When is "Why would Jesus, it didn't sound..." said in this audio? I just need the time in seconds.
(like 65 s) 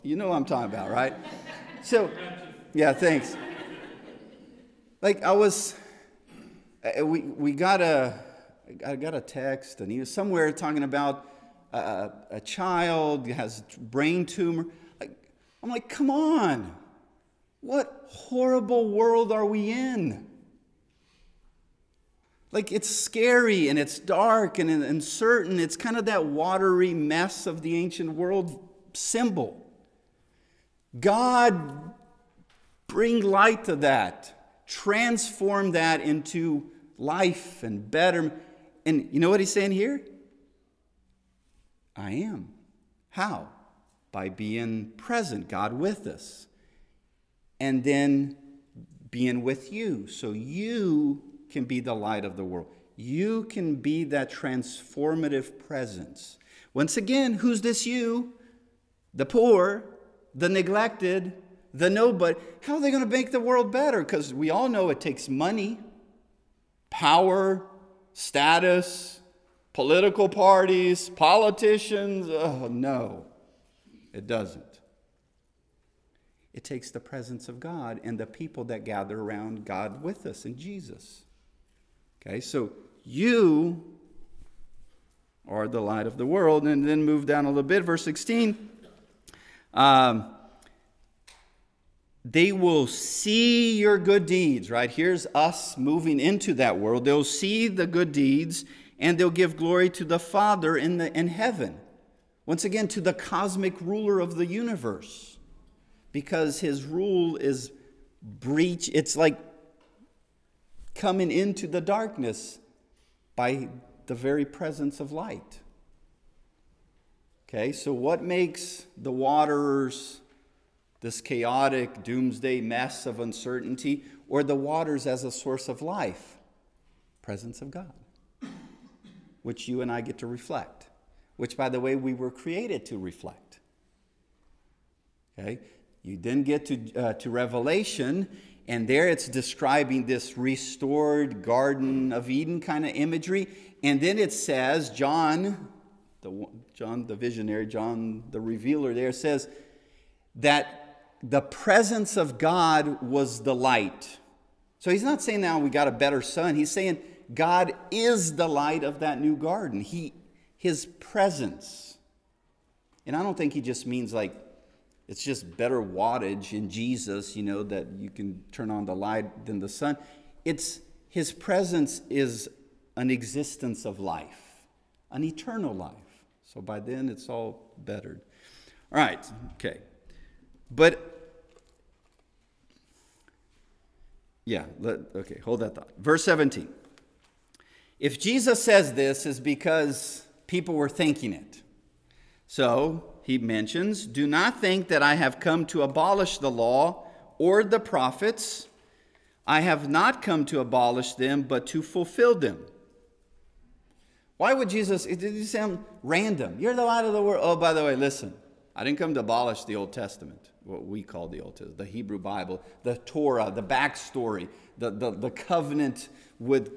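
204 s.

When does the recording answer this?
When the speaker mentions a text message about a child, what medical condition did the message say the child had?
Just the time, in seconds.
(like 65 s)
13 s.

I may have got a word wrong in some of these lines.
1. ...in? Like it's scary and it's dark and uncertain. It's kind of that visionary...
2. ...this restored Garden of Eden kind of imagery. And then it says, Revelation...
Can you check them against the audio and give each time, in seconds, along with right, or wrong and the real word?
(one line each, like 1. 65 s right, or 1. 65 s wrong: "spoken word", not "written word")
1. 19 s wrong: "watery", not "visionary"
2. 140 s wrong: "John", not "Revelation".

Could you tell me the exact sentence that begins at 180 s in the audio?
But yeah, let, okay, hold that thought.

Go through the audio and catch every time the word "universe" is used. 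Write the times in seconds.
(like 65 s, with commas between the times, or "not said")
104 s.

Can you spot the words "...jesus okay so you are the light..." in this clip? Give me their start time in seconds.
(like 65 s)
80 s.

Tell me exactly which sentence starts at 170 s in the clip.
It's his presence is an existence of life, an eternal life.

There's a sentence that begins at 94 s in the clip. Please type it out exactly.
Here's us moving into that world.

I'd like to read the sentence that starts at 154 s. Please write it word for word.
So he's not saying now we got a better sun.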